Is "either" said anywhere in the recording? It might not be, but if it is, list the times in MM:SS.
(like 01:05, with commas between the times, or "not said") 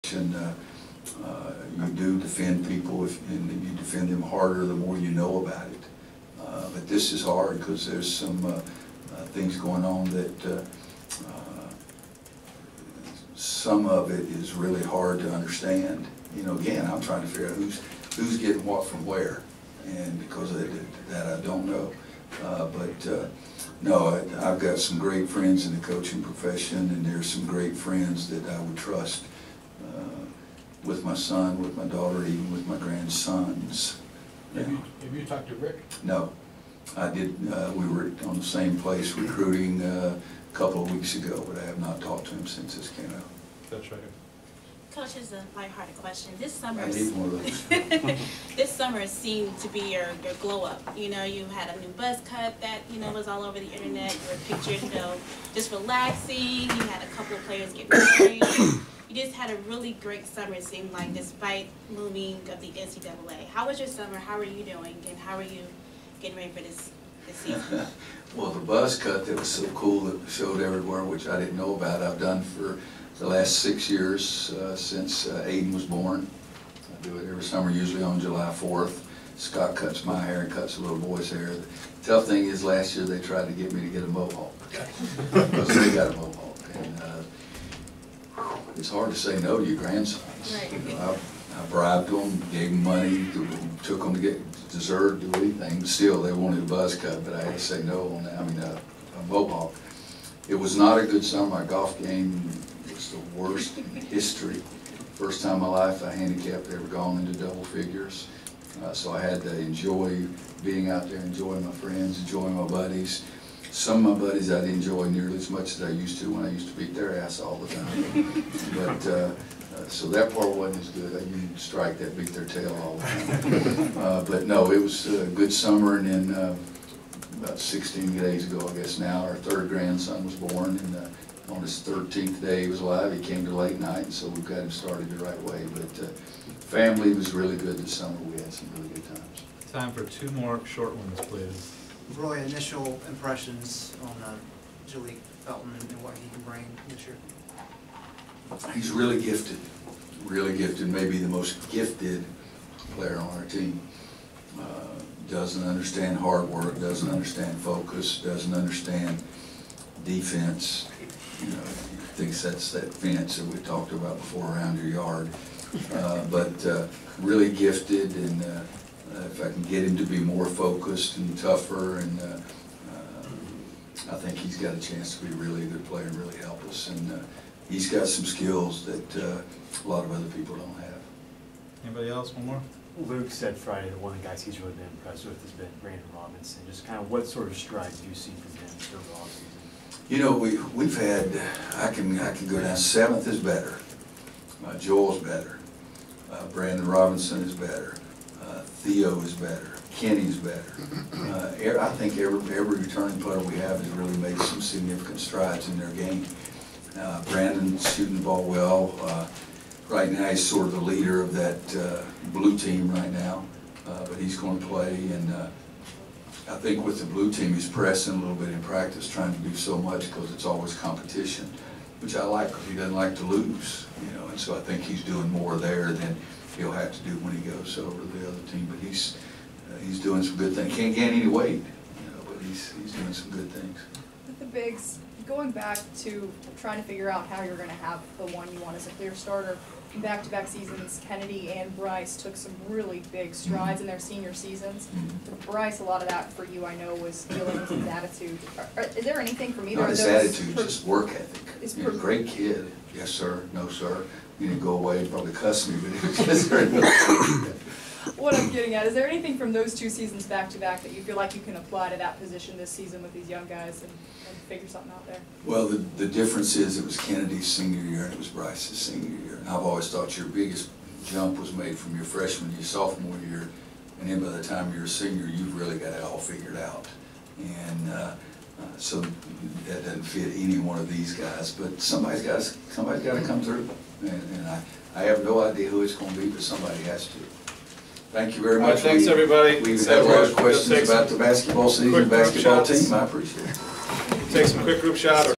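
04:09.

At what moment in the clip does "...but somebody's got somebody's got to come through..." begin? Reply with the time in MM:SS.
04:41.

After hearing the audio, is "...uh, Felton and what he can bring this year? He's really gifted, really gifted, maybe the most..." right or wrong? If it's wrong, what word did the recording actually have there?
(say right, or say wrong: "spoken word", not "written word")
right.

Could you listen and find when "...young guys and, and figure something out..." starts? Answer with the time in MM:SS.
04:23.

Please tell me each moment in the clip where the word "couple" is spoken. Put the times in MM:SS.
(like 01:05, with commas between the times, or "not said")
00:40, 00:57.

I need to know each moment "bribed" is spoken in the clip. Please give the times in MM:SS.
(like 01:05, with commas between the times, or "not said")
01:31.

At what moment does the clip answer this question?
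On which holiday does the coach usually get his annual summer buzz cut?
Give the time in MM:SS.
01:18.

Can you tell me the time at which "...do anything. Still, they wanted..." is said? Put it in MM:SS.
01:35.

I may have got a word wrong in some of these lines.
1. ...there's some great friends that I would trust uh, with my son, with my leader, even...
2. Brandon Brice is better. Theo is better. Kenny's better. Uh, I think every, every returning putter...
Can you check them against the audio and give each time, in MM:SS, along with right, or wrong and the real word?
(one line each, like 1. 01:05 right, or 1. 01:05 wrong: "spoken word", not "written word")
1. 00:27 wrong: "daughter", not "leader"
2. 03:16 wrong: "Robinson", not "Brice".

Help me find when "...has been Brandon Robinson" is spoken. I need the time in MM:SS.
03:05.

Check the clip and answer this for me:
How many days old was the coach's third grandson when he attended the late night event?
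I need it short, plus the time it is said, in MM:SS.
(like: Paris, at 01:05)
13, at 02:11.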